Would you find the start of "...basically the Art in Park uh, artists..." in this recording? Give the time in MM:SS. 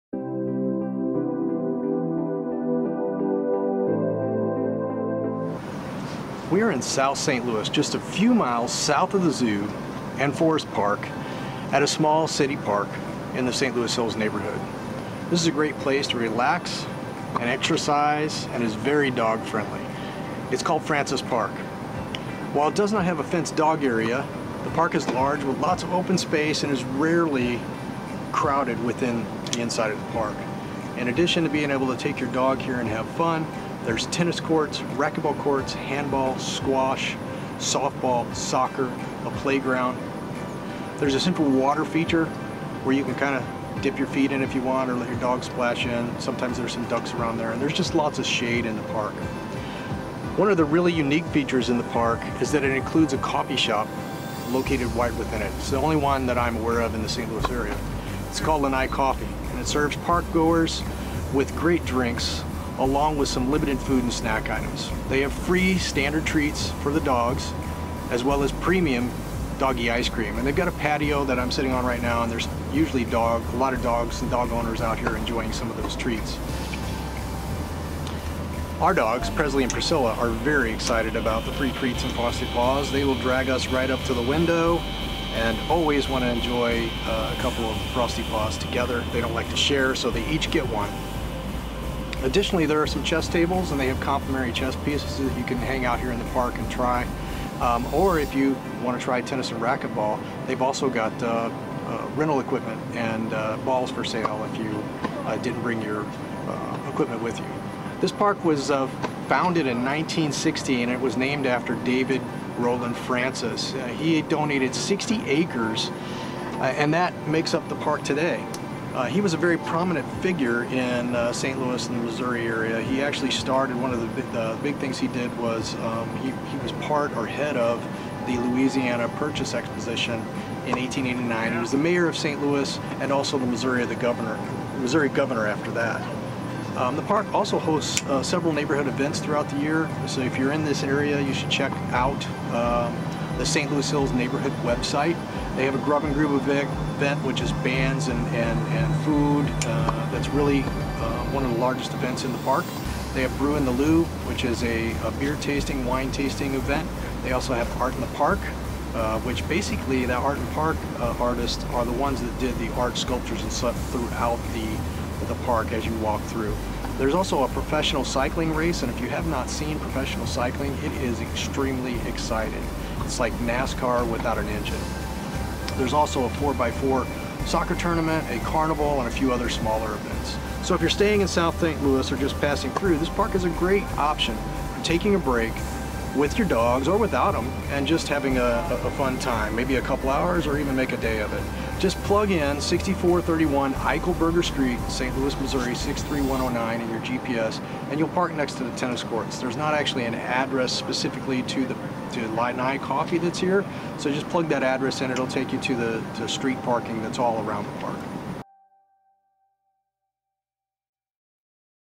02:39.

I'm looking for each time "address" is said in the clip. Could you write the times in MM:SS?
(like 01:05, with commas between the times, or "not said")
03:20, 03:24.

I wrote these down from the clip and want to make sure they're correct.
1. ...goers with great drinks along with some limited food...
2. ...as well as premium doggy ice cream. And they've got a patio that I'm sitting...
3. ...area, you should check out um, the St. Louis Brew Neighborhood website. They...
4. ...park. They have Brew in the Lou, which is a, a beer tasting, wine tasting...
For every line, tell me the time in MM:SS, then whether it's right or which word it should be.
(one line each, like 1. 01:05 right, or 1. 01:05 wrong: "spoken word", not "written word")
1. 01:00 right
2. 01:08 right
3. 02:20 wrong: "Hills", not "Brew"
4. 02:32 right.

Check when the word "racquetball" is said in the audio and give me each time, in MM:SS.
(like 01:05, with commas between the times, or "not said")
00:34, 01:39.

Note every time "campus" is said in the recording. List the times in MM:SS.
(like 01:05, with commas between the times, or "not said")
not said.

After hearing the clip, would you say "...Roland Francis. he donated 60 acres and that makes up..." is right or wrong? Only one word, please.
right.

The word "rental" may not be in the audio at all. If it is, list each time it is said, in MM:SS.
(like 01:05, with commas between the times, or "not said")
01:42.